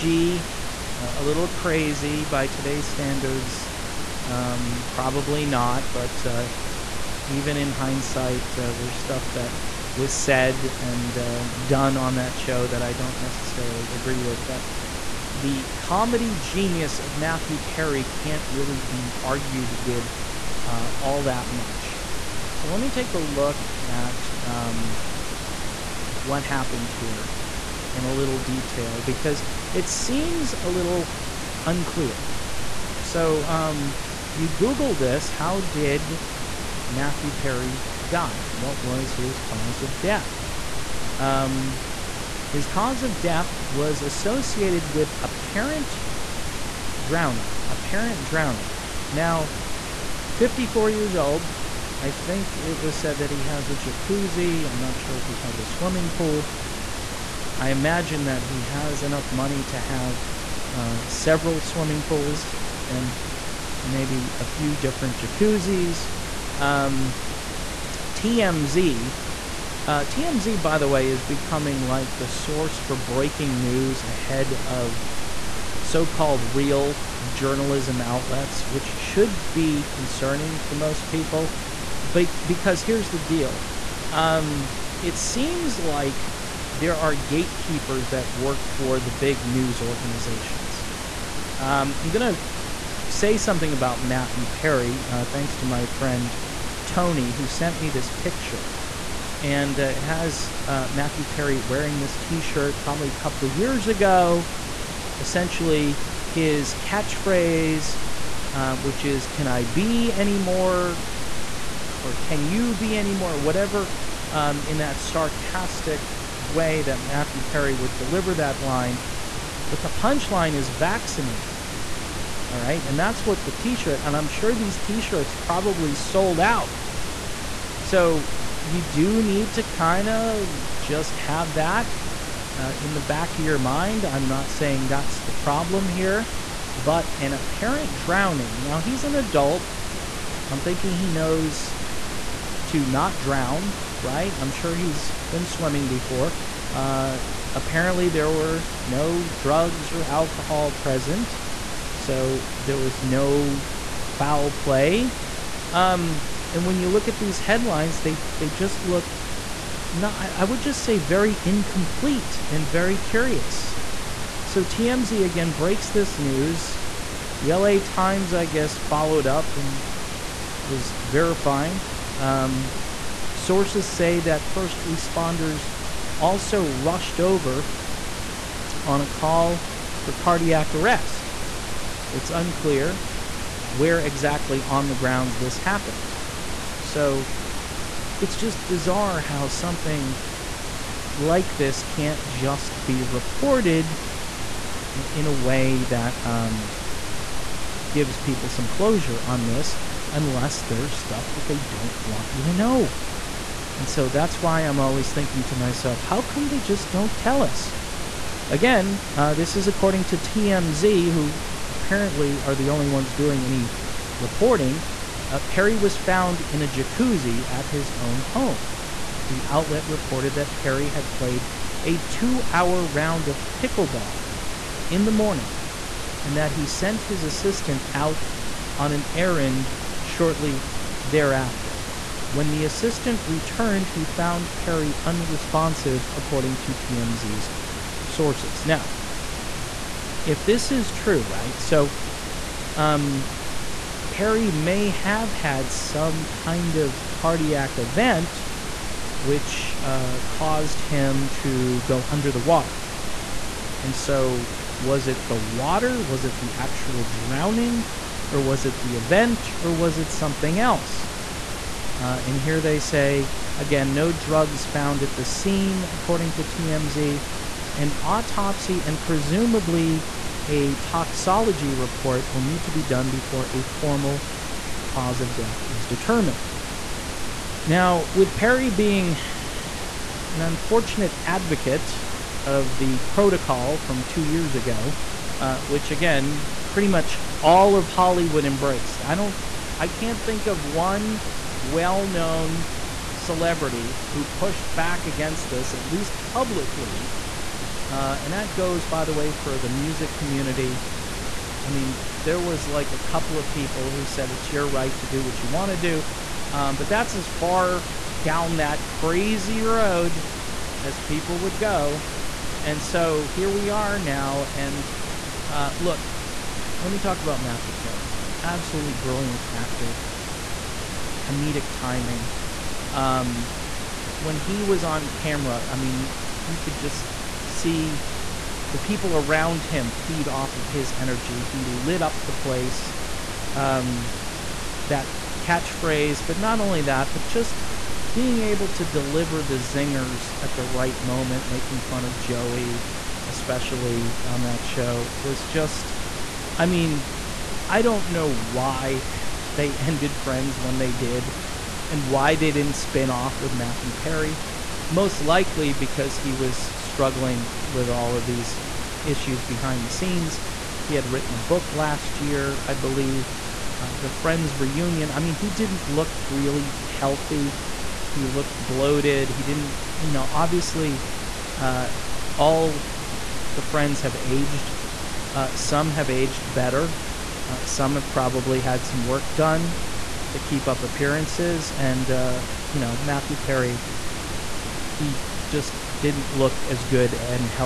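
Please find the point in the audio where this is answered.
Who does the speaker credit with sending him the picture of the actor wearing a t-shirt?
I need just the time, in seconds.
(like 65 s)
96 s.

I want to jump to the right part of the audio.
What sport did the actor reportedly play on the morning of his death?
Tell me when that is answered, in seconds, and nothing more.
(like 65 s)
223 s.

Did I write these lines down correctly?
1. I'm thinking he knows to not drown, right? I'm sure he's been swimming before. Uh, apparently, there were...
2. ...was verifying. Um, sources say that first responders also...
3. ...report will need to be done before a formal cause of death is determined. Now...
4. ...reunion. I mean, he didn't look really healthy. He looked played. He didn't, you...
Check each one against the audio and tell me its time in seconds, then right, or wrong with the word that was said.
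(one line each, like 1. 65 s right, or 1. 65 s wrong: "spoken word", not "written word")
1. 140 s right
2. 170 s right
3. 271 s right
4. 364 s wrong: "bloated", not "played".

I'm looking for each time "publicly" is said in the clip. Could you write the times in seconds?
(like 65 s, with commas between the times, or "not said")
296 s.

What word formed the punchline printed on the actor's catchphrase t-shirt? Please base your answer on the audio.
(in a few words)
vaccinated.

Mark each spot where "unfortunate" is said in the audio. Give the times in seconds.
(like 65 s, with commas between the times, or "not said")
280 s.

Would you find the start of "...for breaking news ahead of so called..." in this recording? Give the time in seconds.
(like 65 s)
72 s.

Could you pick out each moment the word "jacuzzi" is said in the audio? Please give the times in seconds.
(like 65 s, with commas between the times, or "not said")
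53 s, 65 s, 216 s.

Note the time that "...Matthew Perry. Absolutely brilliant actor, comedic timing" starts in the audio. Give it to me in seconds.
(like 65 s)
317 s.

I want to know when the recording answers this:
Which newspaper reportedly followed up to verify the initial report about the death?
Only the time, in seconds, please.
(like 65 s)
167 s.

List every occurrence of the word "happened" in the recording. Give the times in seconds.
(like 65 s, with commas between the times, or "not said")
26 s, 185 s.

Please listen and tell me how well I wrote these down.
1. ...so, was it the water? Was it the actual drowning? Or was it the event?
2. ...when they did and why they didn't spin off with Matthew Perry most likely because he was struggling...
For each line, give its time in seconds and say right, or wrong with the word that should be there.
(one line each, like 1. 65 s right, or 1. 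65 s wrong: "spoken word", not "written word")
1. 253 s right
2. 350 s right.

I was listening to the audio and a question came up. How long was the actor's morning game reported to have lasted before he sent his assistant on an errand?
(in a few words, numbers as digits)
2 hours.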